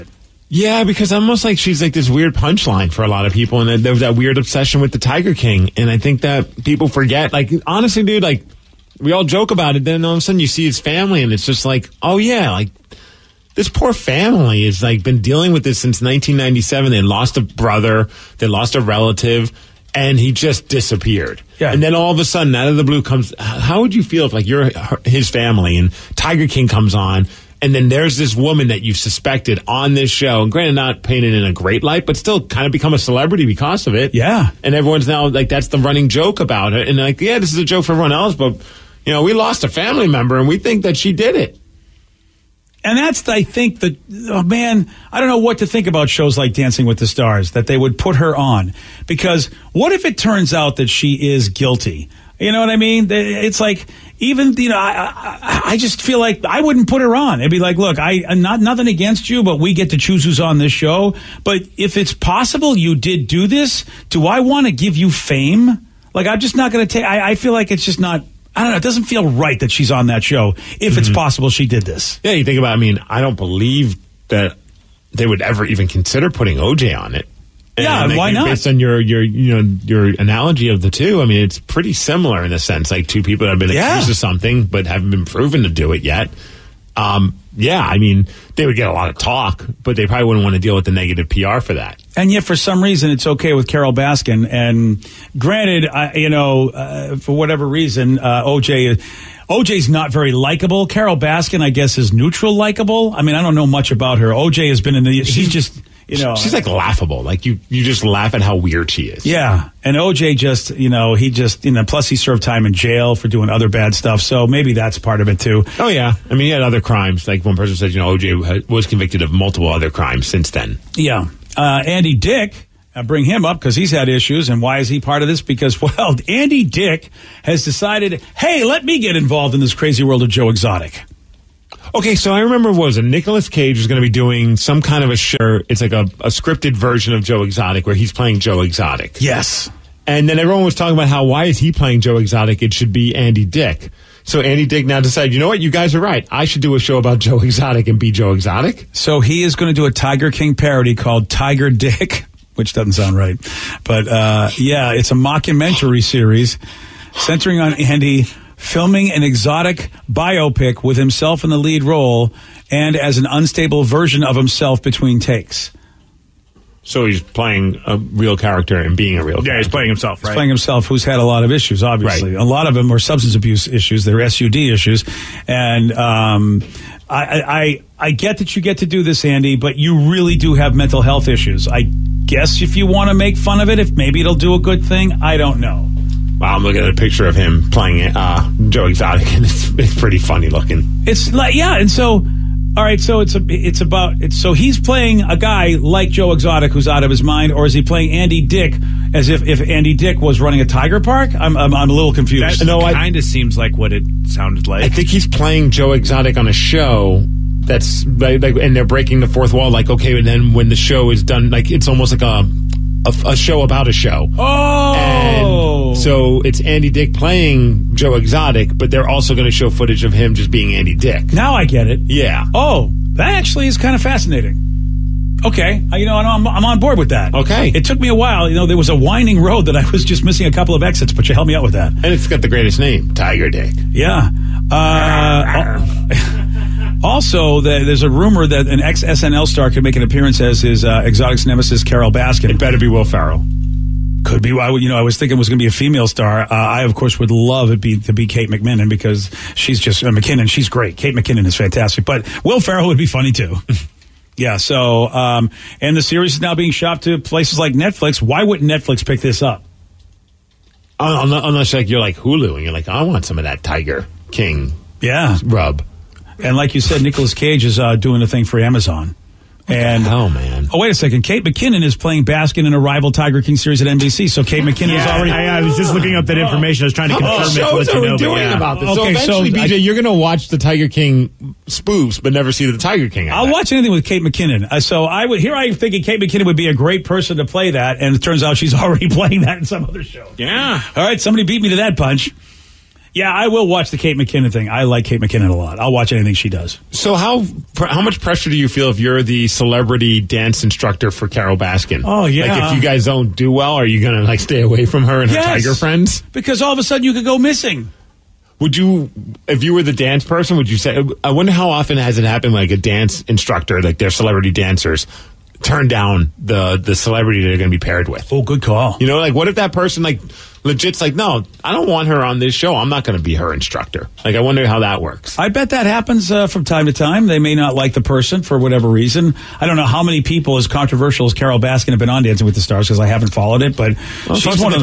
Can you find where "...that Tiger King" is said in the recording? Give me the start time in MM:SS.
04:23.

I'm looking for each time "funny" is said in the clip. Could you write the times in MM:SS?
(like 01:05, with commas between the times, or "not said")
03:10, 04:13.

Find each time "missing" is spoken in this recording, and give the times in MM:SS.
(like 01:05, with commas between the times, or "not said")
03:50, 05:07.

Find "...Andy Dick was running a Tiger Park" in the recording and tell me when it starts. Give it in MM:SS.
03:19.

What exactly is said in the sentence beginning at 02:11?
Okay, so I remember was a Nicolas Cage is going to be doing some kind of a show.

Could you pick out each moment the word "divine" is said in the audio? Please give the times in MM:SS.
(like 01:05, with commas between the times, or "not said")
not said.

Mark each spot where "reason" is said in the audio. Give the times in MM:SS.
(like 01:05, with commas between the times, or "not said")
01:32, 01:37, 05:28.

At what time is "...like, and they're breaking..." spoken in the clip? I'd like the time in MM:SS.
03:28.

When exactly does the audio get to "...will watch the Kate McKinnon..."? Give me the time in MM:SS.
04:53.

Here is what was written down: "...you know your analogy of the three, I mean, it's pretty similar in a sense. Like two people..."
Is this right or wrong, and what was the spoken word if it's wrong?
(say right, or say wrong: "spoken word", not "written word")
wrong: "two", not "three".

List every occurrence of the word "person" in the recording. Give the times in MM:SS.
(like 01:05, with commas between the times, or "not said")
01:57, 04:47, 05:10, 05:19, 05:28.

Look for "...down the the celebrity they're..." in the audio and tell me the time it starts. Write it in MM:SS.
05:15.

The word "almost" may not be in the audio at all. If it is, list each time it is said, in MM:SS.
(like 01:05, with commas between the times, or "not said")
00:01, 03:31.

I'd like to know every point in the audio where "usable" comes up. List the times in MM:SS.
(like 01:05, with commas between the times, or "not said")
not said.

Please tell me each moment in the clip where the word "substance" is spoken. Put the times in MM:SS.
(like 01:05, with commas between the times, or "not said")
02:52.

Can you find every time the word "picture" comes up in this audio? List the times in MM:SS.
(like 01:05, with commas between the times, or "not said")
03:06.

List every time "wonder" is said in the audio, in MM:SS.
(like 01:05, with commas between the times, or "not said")
05:11, 05:24.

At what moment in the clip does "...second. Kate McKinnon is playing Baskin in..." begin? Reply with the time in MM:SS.
04:30.